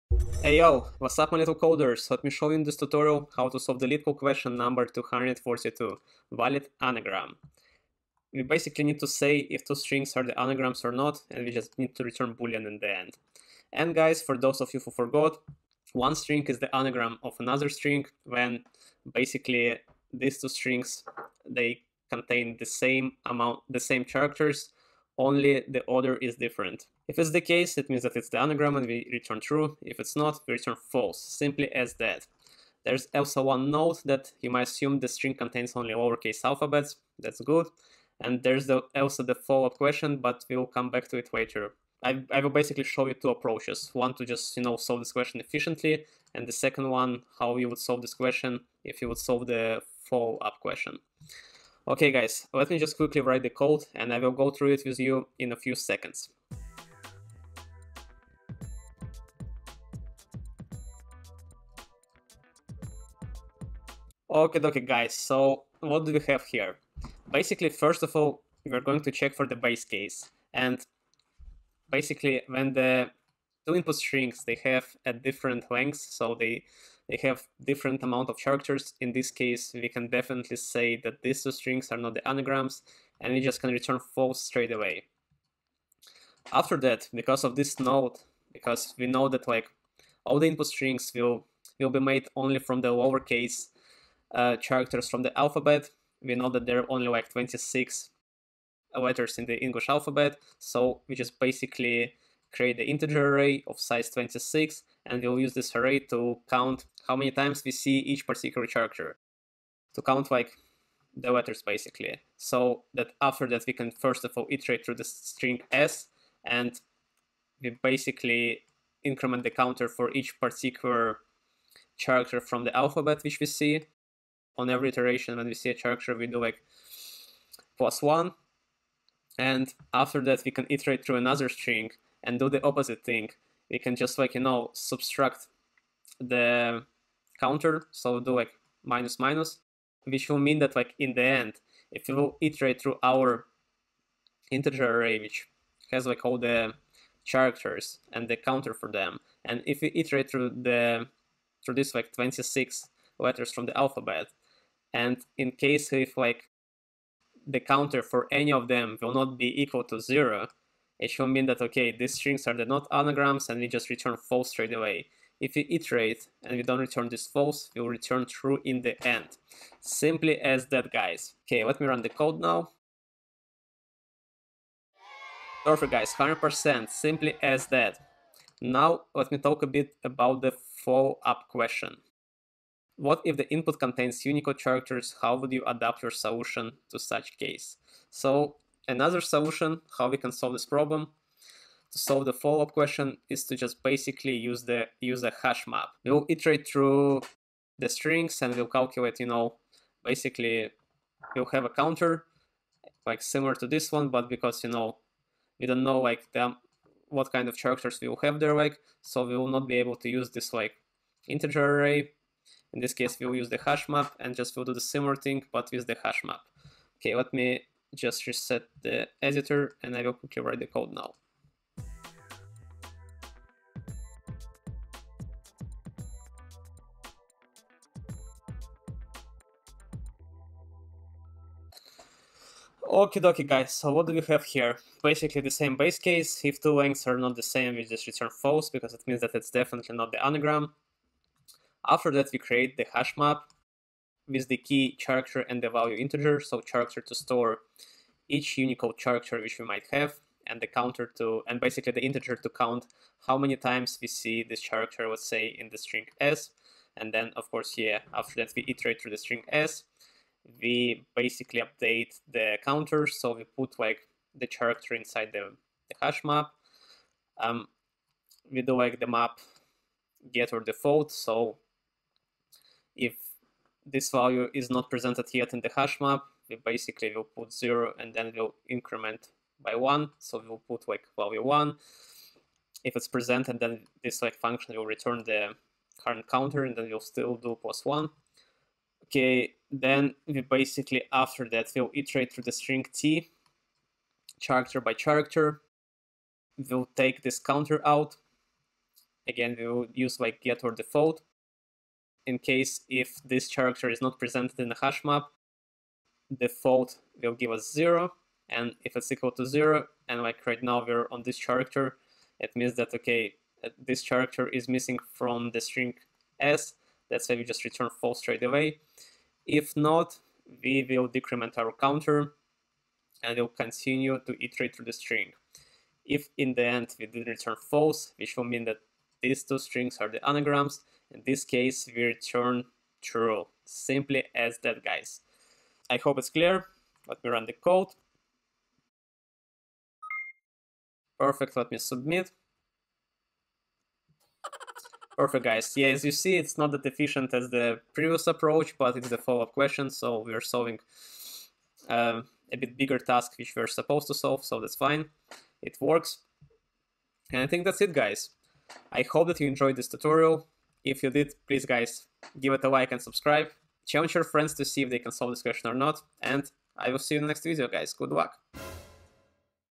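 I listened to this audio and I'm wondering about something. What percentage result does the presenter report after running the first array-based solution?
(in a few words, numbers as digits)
100%.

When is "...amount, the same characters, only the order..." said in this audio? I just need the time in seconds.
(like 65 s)
23 s.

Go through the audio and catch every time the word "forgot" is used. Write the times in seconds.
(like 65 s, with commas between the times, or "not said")
14 s.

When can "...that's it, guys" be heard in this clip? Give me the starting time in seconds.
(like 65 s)
357 s.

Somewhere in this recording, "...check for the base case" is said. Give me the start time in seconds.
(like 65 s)
69 s.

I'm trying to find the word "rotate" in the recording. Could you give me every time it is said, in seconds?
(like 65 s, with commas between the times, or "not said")
not said.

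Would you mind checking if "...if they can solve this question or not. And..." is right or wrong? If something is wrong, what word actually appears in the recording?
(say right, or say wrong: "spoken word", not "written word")
right.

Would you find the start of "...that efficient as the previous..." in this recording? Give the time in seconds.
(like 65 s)
346 s.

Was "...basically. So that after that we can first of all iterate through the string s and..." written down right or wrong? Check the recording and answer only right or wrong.
right.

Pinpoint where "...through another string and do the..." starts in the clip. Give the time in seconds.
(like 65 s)
131 s.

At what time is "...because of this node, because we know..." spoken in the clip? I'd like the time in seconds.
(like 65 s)
87 s.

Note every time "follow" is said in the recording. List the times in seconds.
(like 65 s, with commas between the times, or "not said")
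39 s, 50 s, 180 s, 192 s, 349 s.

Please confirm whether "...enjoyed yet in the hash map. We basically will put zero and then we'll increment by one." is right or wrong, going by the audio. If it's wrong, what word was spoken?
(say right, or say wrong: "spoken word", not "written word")
wrong: "presented", not "enjoyed".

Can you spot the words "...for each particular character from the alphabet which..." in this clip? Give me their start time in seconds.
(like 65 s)
119 s.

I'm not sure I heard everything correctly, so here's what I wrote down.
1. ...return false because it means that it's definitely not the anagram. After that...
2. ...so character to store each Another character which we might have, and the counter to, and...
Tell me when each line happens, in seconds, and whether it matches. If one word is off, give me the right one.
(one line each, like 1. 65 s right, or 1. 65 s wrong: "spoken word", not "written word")
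1. 238 s right
2. 246 s wrong: "Unicode", not "Another".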